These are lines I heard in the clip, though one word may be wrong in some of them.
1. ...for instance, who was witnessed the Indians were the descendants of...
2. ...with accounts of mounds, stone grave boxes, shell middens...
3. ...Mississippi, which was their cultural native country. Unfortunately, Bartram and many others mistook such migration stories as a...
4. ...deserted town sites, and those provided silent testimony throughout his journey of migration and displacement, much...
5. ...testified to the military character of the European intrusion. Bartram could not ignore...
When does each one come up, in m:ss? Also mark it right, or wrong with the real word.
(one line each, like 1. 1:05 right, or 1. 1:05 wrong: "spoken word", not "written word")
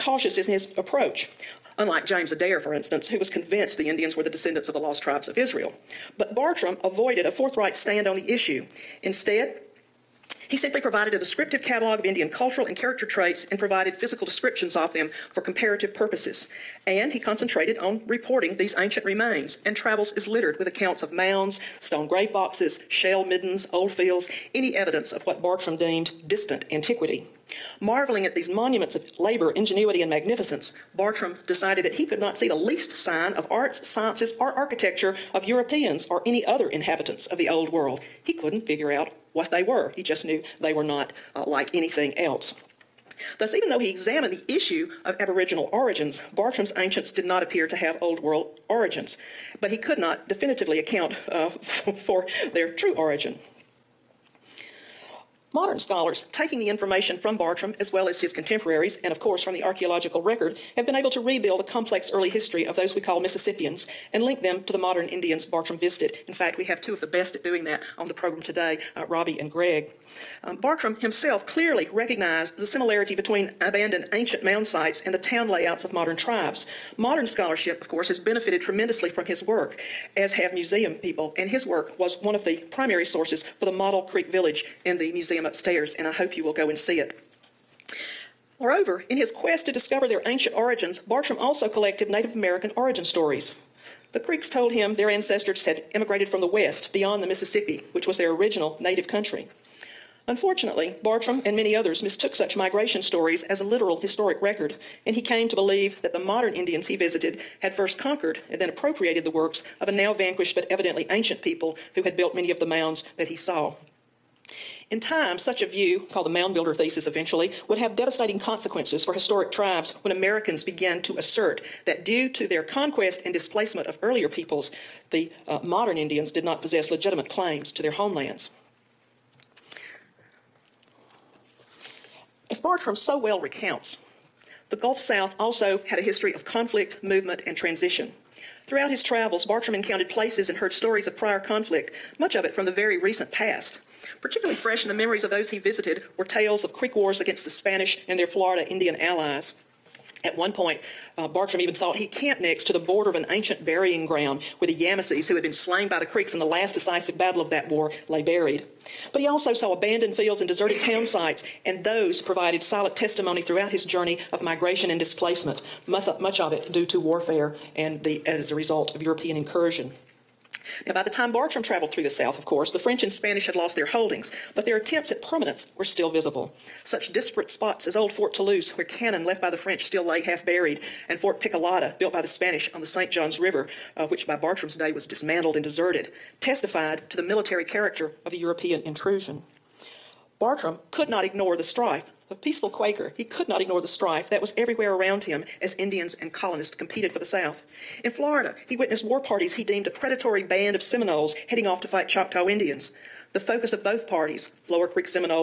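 1. 0:02 wrong: "convinced", not "witnessed"
2. 0:20 right
3. 1:37 wrong: "original", not "cultural"
4. 2:40 right
5. 3:06 right.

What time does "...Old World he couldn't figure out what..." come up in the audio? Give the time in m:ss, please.
0:37.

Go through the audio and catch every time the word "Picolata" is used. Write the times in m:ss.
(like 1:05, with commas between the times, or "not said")
3:01.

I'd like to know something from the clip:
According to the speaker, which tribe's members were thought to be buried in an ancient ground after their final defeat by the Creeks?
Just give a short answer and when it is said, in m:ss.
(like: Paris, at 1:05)
Yamasees, at 2:34.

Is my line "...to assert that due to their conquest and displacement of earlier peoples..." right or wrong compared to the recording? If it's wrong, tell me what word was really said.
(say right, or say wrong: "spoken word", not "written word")
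right.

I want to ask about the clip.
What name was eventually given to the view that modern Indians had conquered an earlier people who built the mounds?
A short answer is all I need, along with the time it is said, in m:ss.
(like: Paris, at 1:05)
mound builder thesis, at 1:56.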